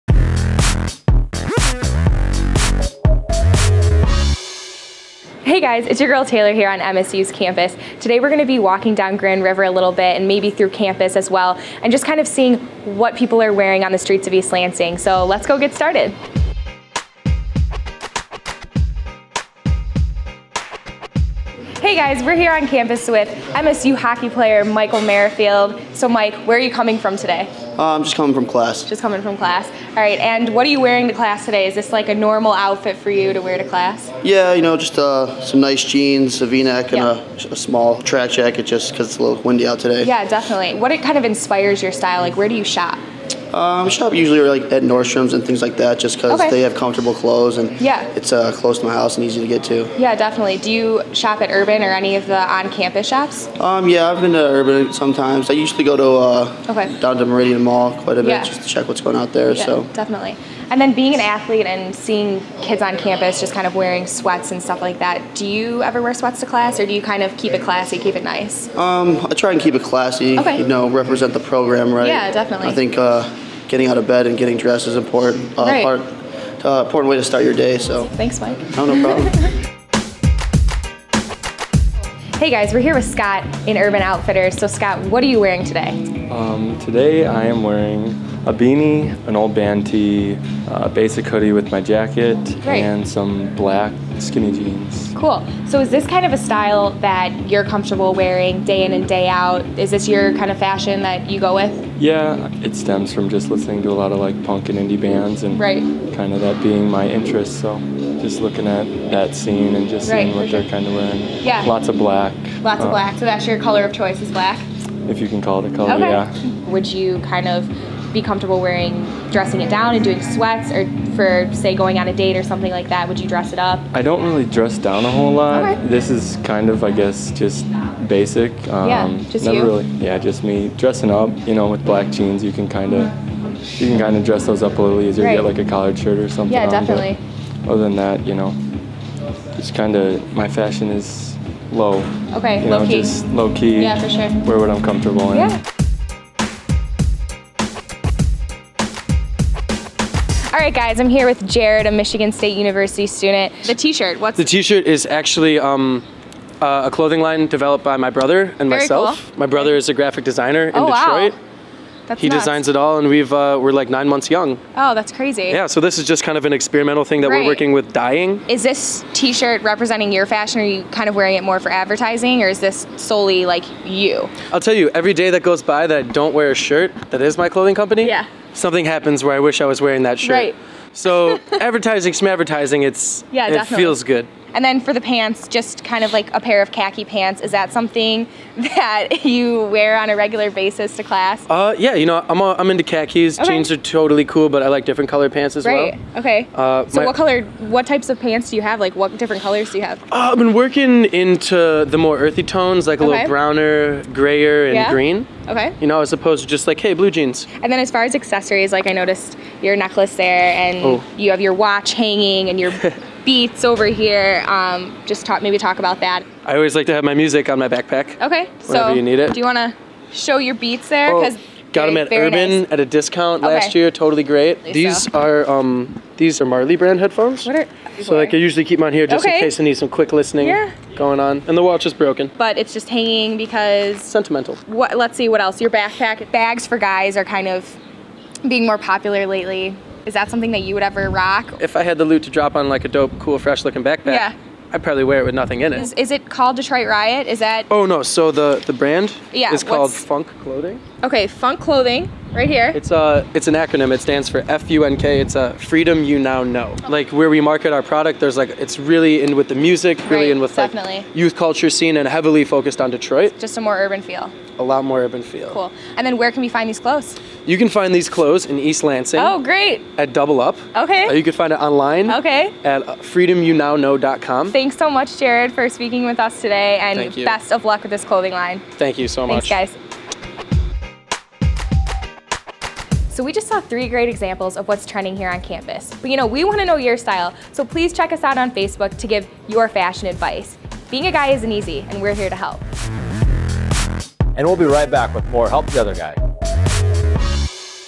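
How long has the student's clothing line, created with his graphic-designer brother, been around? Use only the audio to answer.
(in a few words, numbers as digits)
9 months.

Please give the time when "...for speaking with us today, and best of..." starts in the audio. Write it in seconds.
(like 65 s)
275 s.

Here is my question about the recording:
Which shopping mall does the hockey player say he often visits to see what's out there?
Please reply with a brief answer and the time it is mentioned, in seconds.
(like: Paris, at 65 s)
Meridian Mall, at 57 s.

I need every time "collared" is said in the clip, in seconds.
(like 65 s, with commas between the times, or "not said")
135 s.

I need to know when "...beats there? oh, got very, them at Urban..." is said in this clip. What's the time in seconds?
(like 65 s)
220 s.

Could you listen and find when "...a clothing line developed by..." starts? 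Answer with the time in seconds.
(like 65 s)
156 s.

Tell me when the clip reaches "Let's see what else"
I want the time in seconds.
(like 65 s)
234 s.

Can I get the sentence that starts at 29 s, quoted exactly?
All right, and what are you wearing to class today?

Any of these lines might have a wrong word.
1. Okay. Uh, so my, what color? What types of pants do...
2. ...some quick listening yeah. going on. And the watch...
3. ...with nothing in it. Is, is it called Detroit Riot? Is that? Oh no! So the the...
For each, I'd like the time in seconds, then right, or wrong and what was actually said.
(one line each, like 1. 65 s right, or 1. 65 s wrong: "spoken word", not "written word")
1. 196 s right
2. 229 s right
3. 245 s right.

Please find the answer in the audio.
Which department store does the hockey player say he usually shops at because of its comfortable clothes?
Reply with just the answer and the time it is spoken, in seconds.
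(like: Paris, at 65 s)
Nordstrom's, at 44 s.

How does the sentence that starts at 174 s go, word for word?
I'll tell you, every day that goes by that I don't wear a shirt that is my clothing company, yeah.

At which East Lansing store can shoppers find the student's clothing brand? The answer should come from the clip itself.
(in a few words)
Double Up.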